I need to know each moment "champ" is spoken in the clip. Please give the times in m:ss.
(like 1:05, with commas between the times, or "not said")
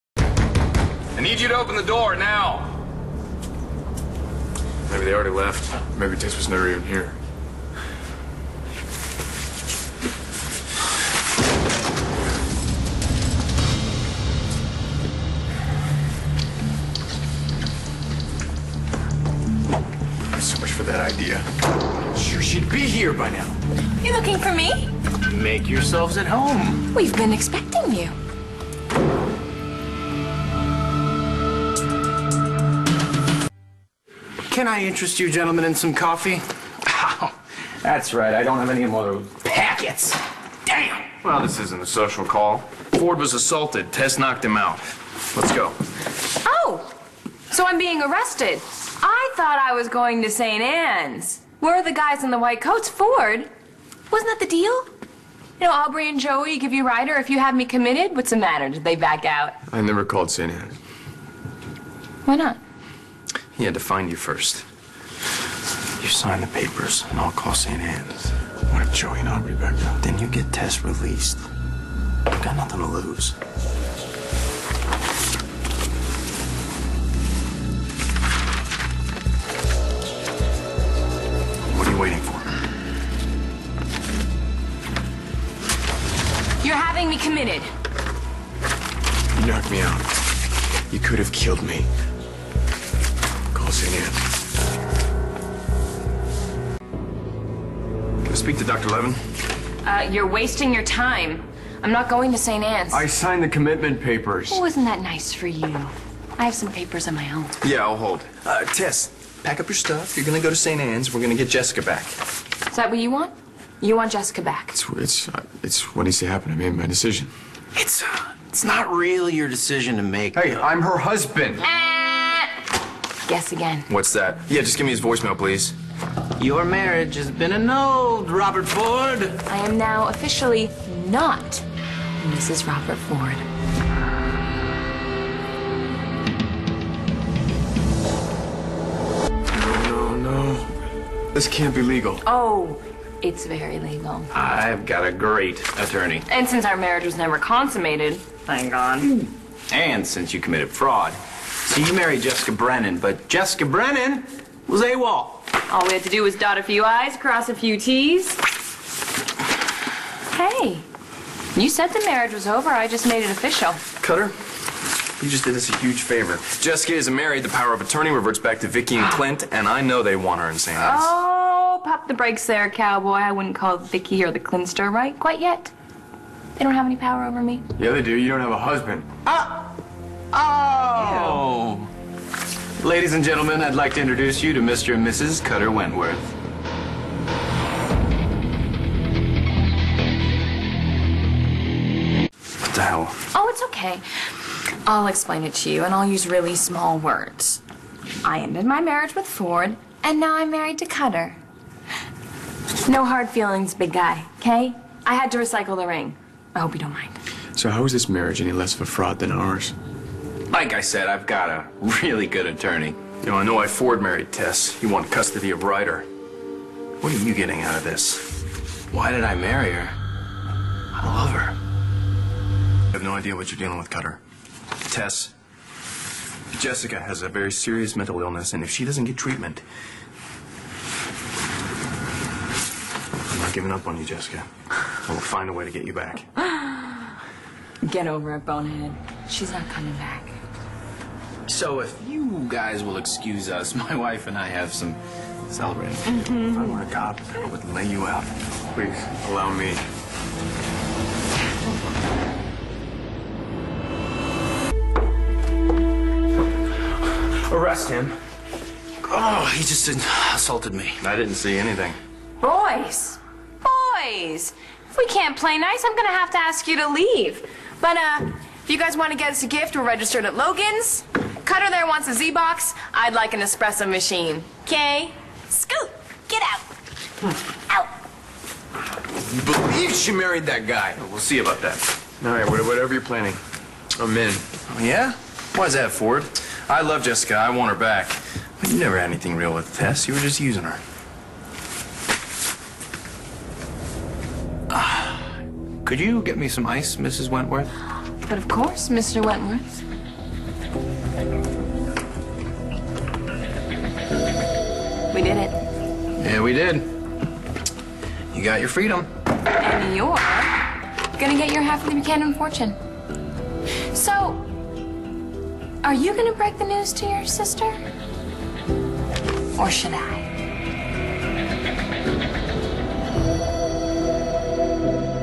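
not said.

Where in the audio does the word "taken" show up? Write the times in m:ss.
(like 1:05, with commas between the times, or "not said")
not said.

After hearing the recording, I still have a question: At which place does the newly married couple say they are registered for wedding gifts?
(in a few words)
Logan's.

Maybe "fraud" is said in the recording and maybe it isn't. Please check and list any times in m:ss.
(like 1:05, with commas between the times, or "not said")
2:30, 3:28.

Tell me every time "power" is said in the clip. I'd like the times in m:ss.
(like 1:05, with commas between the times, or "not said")
2:47, 2:56.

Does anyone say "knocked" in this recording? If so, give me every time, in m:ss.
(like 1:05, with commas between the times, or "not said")
0:44, 1:29.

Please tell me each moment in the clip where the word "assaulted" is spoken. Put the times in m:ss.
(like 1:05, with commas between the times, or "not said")
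0:43, 4:20.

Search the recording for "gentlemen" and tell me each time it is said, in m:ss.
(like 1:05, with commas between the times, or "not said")
0:35, 3:03.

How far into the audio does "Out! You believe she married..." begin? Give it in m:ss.
4:38.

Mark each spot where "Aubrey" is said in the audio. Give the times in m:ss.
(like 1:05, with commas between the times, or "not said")
0:55.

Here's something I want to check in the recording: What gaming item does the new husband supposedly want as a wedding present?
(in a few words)
Z-Box.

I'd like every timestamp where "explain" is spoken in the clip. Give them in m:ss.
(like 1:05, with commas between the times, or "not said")
3:15.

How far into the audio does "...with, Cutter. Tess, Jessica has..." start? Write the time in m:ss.
3:43.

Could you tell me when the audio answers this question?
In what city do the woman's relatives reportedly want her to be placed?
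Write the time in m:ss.
2:50.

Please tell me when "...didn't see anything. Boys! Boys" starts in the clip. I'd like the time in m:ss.
4:21.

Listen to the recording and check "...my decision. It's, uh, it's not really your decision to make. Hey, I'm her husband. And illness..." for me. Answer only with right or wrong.
wrong.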